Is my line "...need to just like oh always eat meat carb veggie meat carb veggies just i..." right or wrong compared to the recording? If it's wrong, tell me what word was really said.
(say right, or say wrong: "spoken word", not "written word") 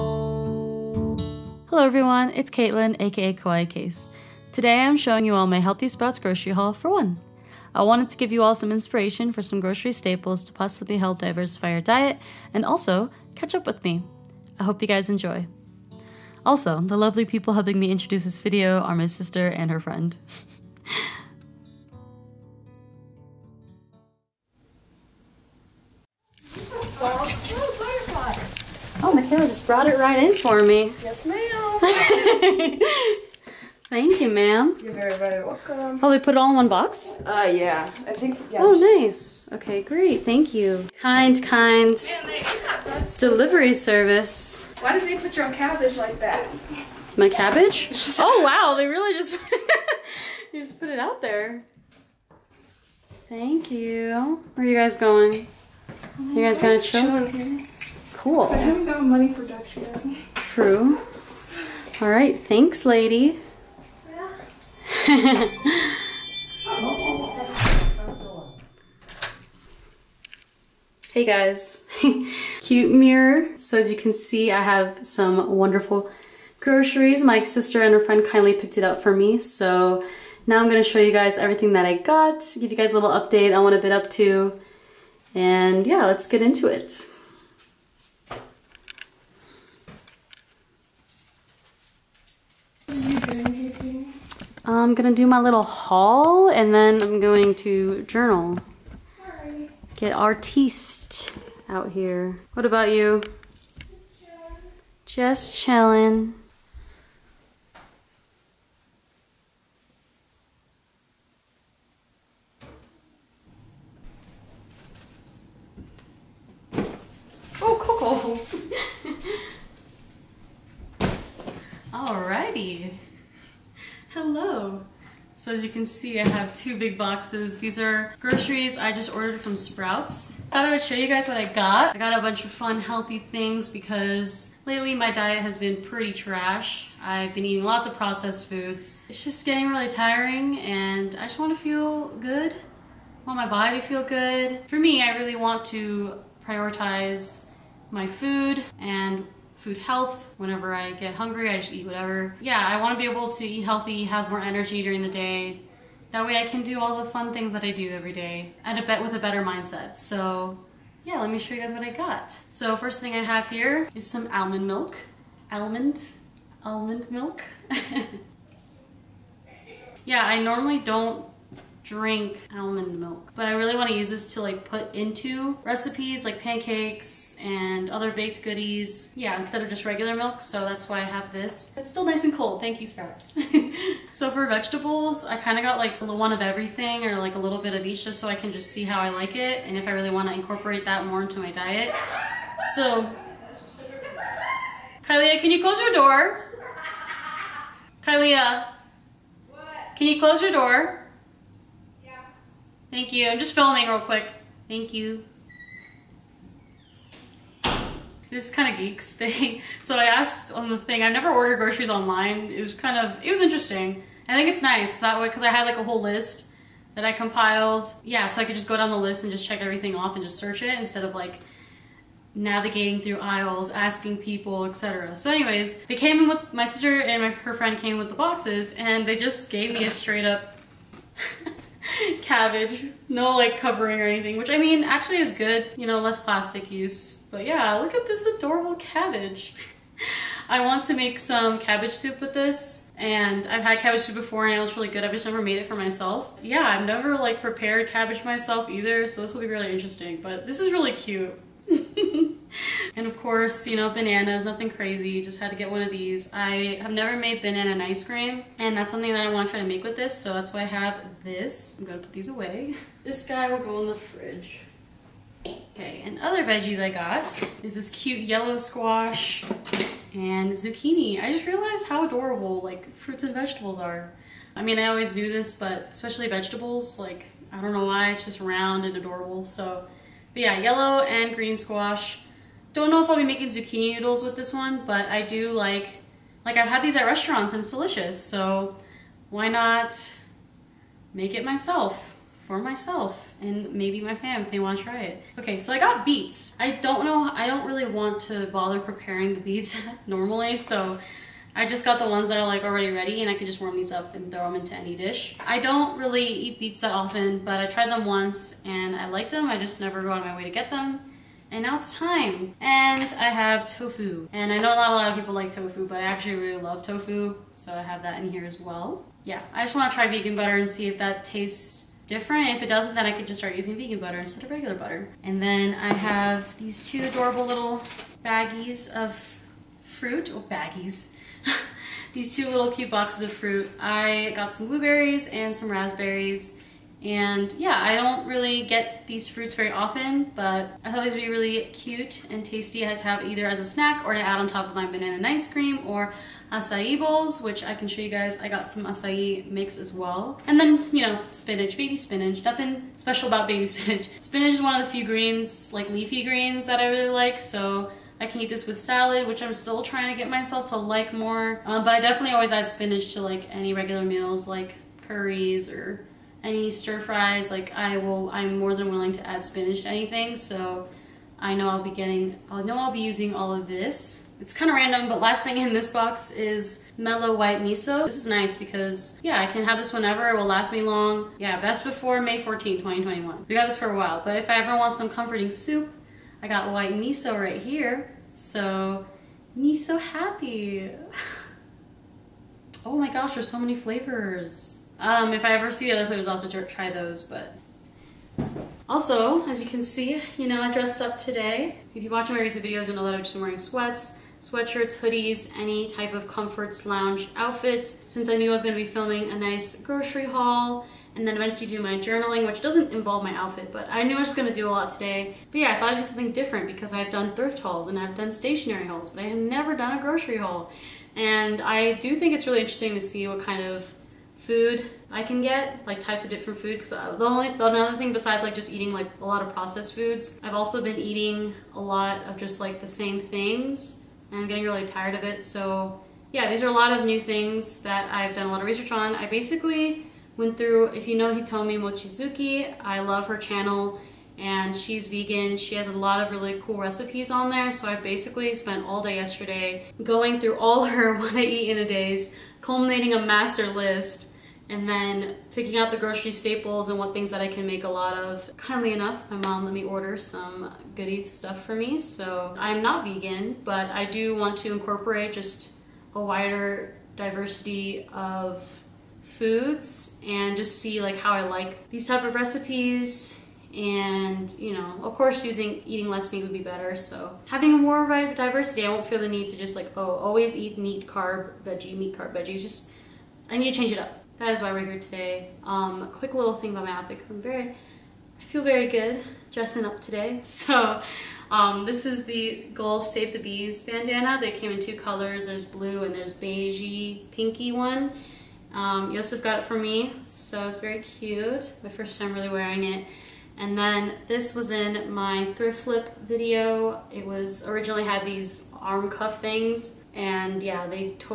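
right.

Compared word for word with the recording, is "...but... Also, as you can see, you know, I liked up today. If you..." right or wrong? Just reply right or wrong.
wrong.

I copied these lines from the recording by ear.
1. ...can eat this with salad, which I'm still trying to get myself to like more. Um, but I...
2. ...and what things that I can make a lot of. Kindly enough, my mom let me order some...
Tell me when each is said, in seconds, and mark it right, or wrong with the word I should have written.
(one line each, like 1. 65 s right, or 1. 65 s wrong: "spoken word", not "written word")
1. 358 s right
2. 456 s right.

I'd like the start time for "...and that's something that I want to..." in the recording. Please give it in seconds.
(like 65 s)
258 s.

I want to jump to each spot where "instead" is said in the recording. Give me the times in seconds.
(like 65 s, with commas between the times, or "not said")
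179 s, 220 s, 324 s.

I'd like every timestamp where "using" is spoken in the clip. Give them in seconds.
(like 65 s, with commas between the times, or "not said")
323 s, 373 s, 475 s.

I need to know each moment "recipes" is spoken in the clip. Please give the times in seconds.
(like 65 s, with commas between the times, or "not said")
175 s, 446 s, 472 s.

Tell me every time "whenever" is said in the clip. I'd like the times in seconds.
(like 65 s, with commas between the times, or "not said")
150 s, 379 s.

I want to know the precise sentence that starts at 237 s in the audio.
But yeah, look at this adorable cabbage.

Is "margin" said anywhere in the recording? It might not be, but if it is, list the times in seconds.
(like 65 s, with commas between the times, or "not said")
not said.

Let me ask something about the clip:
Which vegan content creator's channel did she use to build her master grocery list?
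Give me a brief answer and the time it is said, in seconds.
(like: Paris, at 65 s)
Hitomi Mochizuki, at 441 s.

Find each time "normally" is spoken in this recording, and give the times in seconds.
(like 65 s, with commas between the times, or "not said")
170 s, 300 s.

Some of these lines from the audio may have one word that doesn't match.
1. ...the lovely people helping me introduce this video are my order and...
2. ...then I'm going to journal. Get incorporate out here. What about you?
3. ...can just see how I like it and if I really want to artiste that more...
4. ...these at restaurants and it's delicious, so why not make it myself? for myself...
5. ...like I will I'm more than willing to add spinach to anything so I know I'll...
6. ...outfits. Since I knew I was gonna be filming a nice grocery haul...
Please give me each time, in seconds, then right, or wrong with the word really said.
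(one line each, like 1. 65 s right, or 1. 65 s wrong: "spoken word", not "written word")
1. 16 s wrong: "sister", not "order"
2. 96 s wrong: "artiste", not "incorporate"
3. 188 s wrong: "incorporate", not "artiste"
4. 286 s right
5. 367 s right
6. 407 s right.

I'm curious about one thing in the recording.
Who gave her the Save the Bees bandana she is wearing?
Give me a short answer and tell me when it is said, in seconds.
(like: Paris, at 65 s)
Yosef, at 499 s.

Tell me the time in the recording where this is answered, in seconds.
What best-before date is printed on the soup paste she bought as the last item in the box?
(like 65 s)
382 s.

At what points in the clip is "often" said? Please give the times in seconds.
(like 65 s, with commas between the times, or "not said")
306 s, 339 s.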